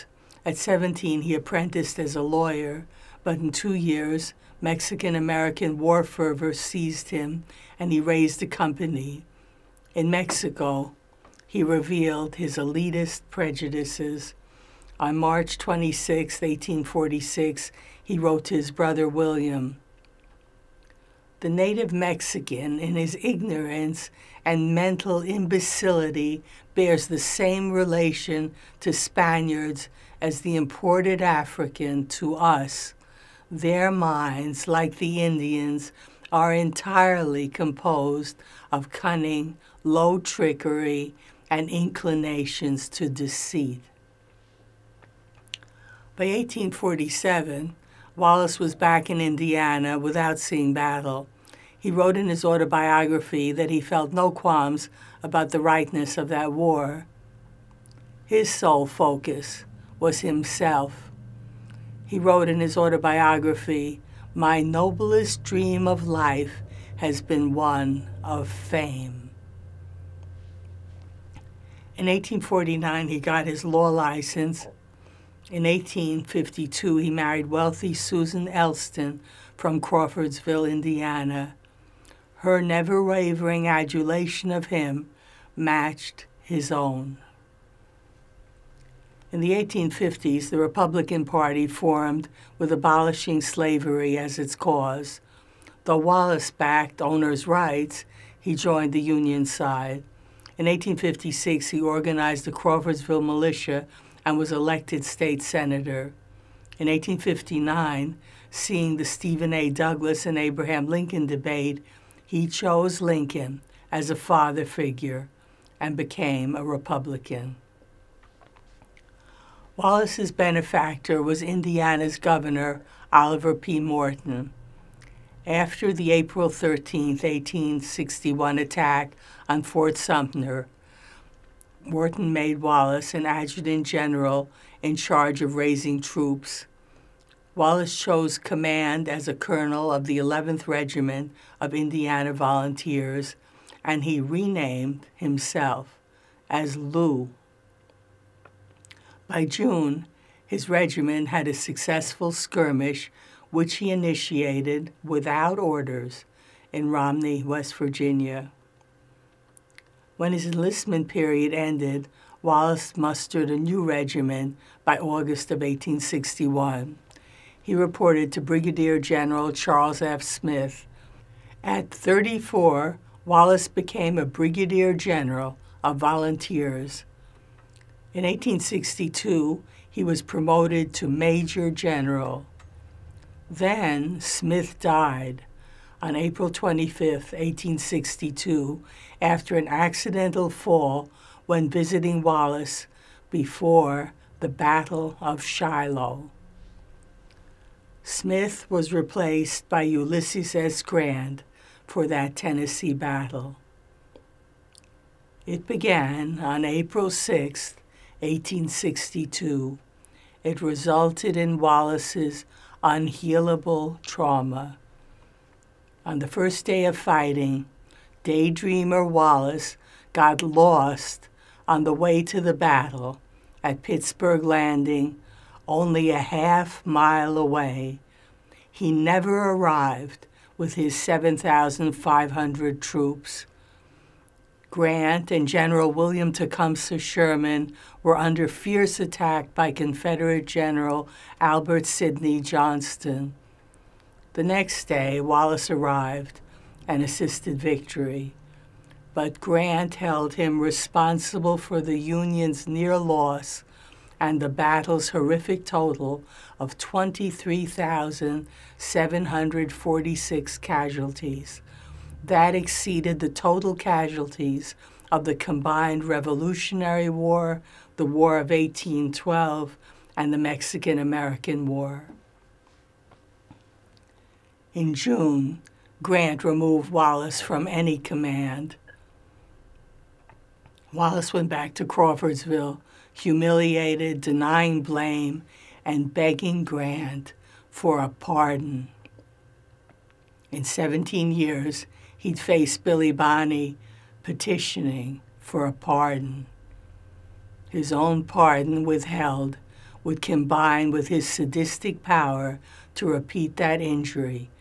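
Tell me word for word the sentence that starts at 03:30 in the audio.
It resulted in Wallace's unhealable trauma.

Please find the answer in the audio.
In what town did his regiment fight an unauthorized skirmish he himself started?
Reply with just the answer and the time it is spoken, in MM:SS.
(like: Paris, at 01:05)
Romney, West Virginia, at 02:36.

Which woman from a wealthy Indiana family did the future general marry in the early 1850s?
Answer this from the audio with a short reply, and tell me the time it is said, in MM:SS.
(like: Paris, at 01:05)
Susan Elston, at 01:17.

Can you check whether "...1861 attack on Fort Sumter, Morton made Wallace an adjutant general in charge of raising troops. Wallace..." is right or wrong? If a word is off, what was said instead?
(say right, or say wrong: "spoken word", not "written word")
right.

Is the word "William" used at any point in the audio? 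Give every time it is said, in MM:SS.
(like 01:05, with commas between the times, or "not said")
00:19, 03:55.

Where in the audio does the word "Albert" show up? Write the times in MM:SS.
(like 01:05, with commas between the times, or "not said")
04:01.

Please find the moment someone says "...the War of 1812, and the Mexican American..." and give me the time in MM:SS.
04:27.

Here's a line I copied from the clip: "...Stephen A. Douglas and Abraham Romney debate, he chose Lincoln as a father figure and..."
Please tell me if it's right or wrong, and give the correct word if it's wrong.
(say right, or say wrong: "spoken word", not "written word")
wrong: "Lincoln", not "Romney".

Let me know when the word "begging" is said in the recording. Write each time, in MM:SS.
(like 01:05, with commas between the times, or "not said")
04:46.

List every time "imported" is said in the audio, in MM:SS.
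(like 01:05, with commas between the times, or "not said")
00:30.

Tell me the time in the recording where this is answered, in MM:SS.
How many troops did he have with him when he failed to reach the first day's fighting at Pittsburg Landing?
03:50.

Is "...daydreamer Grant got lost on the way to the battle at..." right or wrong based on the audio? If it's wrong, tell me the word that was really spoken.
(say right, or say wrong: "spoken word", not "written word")
wrong: "Wallace", not "Grant".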